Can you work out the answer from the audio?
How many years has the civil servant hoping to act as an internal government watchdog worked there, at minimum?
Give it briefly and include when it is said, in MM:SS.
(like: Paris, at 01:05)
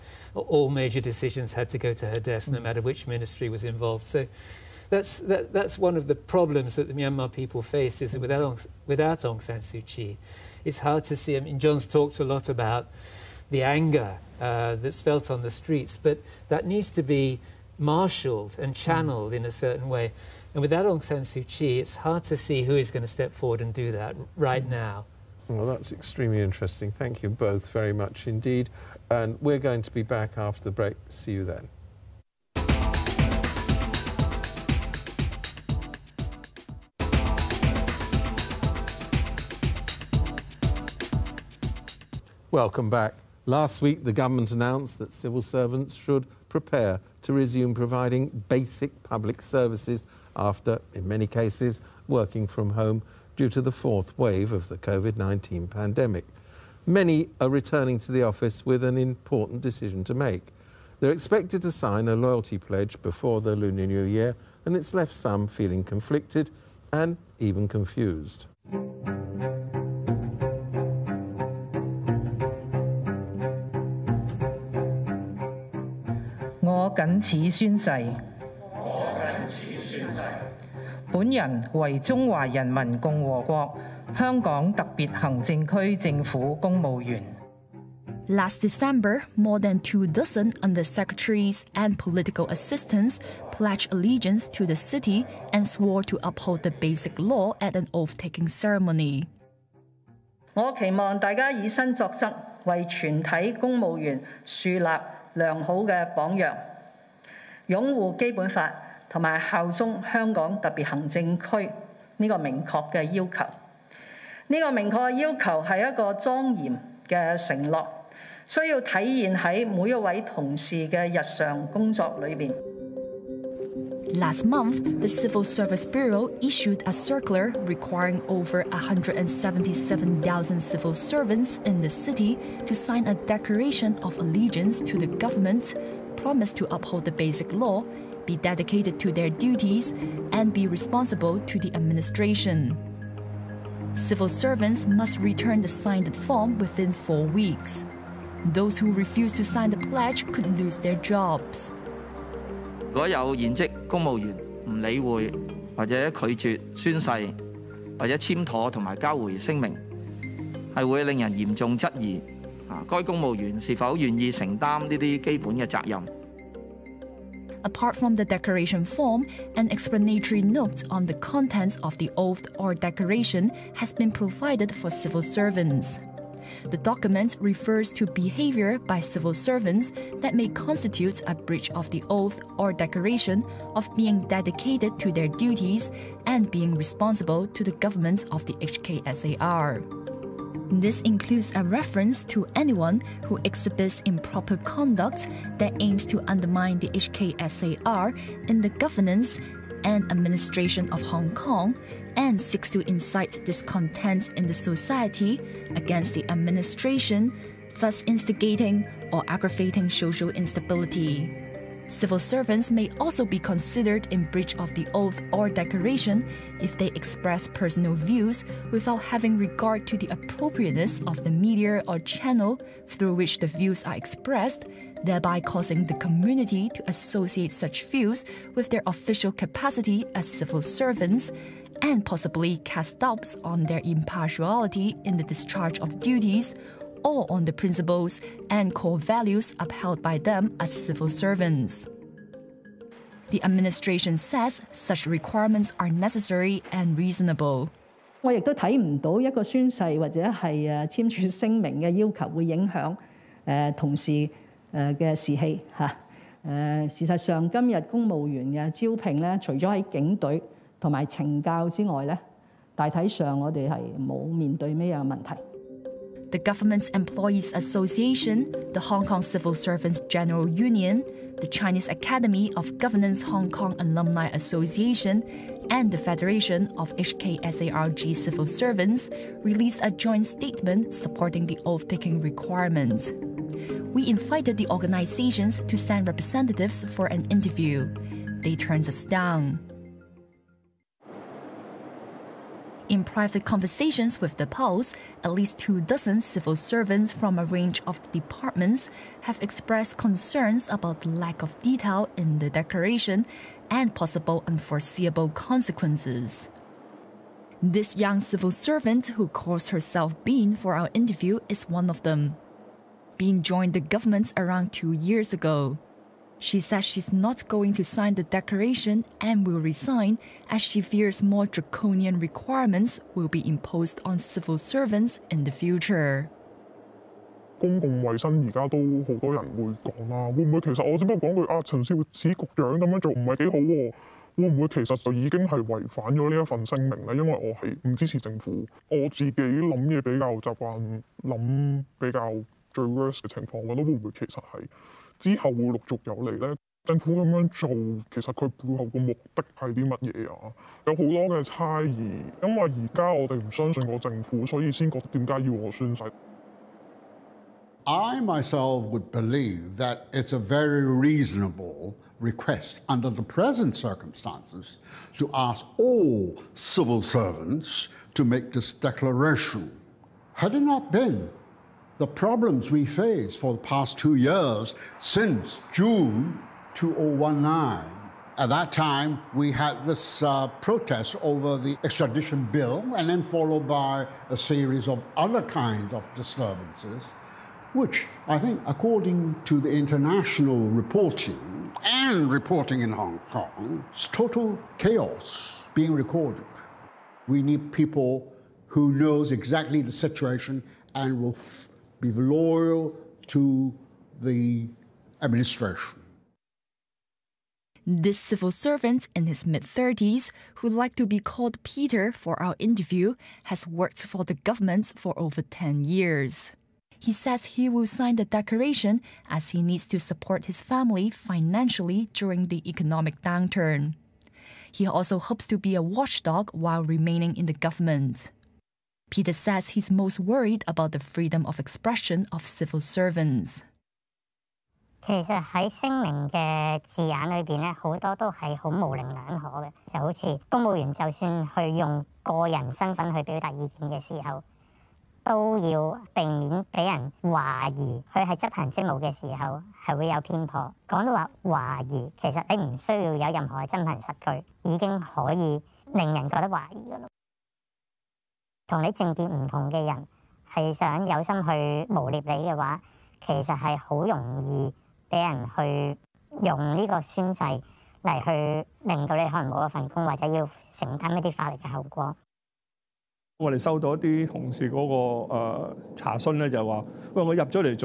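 10, at 06:55.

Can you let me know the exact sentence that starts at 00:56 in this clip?
Many are returning to the office with an important decision to make.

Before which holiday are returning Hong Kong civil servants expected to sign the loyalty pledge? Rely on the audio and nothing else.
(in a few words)
Lunar New Year.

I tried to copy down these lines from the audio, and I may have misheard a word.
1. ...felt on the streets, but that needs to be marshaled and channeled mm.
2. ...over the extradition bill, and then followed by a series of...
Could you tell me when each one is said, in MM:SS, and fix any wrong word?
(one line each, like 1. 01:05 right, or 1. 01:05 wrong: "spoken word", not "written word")
1. 00:15 right
2. 06:21 right.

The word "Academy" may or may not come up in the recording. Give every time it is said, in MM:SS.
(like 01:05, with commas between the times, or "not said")
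04:31.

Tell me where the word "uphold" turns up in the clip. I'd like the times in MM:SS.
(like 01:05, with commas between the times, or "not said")
01:36, 02:16.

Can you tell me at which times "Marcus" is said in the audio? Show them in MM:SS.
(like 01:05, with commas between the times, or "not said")
not said.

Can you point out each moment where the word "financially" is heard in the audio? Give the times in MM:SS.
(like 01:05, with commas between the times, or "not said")
07:01.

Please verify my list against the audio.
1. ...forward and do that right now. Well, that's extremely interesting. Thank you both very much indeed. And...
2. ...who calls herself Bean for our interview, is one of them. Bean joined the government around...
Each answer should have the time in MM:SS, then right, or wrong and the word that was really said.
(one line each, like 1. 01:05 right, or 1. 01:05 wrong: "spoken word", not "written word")
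1. 00:23 right
2. 05:09 right.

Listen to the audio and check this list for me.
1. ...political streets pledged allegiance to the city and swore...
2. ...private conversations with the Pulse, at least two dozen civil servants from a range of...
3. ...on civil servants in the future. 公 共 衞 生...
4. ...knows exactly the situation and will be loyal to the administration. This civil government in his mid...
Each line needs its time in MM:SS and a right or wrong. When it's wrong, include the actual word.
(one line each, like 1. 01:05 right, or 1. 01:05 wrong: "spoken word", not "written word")
1. 01:31 wrong: "assistants", not "streets"
2. 04:53 right
3. 05:24 right
4. 06:38 wrong: "servant", not "government".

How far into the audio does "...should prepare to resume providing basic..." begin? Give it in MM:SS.
00:45.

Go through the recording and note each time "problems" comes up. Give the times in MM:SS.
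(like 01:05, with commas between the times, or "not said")
00:06, 06:12.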